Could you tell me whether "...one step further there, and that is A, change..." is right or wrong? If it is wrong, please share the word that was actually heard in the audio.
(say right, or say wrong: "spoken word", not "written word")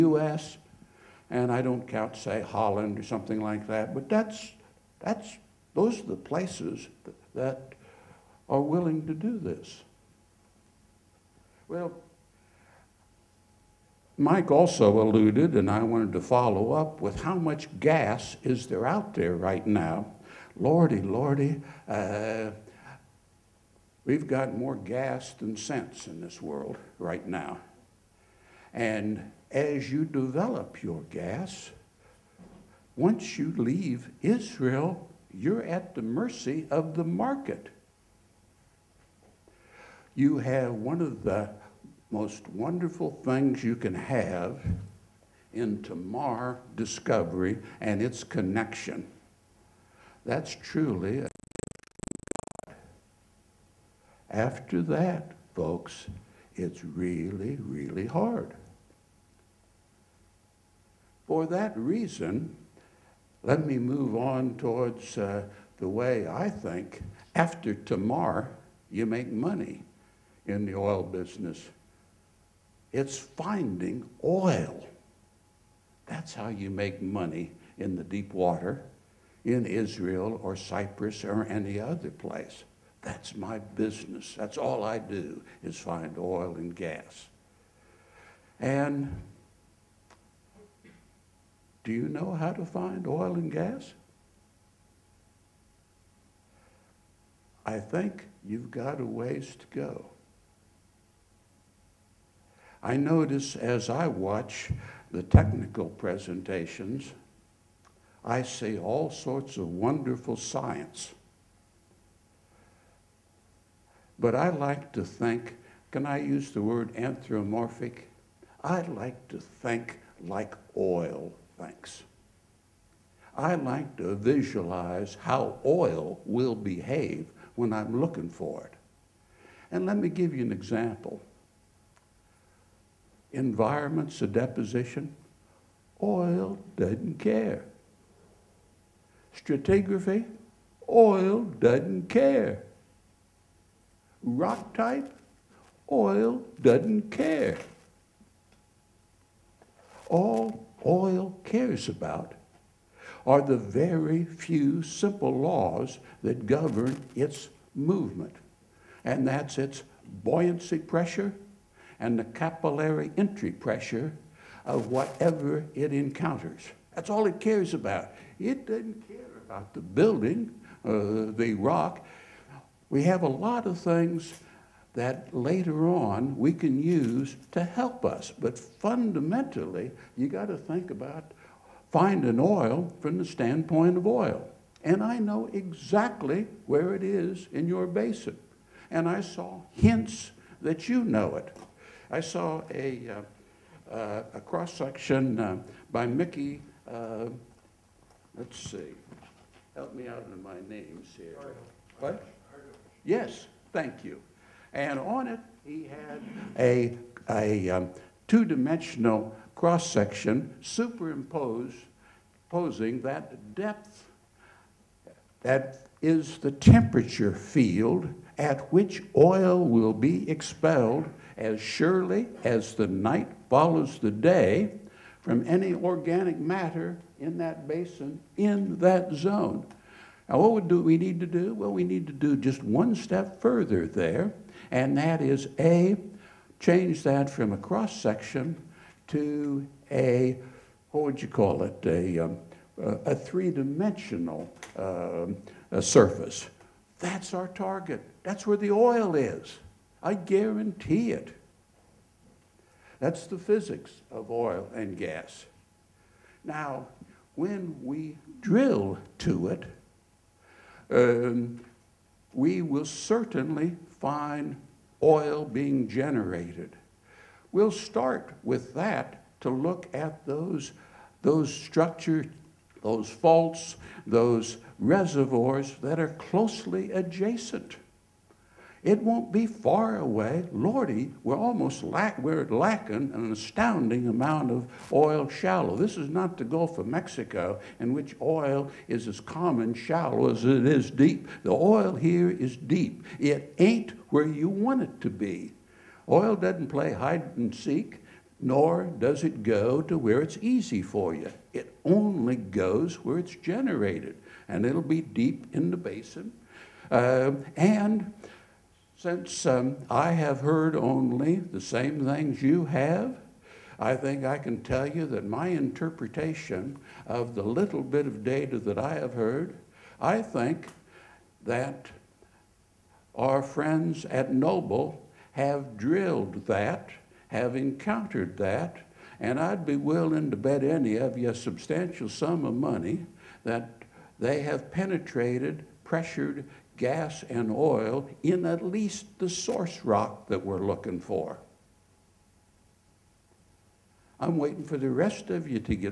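right.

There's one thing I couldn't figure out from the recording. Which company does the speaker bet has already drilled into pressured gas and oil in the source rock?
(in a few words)
Noble.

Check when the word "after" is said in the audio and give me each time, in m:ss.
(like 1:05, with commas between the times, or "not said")
0:54, 1:07.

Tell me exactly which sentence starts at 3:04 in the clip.
And I know exactly where it is in your basin.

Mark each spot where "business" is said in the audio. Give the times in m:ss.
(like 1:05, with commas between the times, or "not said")
1:11, 1:23.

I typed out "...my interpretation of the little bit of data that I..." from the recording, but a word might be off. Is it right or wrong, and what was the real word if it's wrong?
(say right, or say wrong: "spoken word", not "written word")
right.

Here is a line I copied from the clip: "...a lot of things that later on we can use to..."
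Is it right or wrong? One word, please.
right.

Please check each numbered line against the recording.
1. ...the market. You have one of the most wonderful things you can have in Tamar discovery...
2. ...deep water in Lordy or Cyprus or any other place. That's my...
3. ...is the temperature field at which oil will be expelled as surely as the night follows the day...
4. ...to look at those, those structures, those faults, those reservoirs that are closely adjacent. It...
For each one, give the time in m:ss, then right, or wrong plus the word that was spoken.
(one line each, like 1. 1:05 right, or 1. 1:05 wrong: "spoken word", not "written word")
1. 0:36 right
2. 1:18 wrong: "Israel", not "Lordy"
3. 3:36 right
4. 4:29 right.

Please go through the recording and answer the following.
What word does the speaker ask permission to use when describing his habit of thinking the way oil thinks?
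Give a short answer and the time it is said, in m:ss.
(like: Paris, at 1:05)
anthropomorphic, at 1:56.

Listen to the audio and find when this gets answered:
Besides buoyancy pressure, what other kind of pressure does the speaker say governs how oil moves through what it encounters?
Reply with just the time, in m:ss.
2:42.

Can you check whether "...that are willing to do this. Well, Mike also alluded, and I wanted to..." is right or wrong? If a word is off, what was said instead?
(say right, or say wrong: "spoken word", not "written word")
right.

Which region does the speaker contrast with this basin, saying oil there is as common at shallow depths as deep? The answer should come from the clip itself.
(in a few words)
Gulf of Mexico.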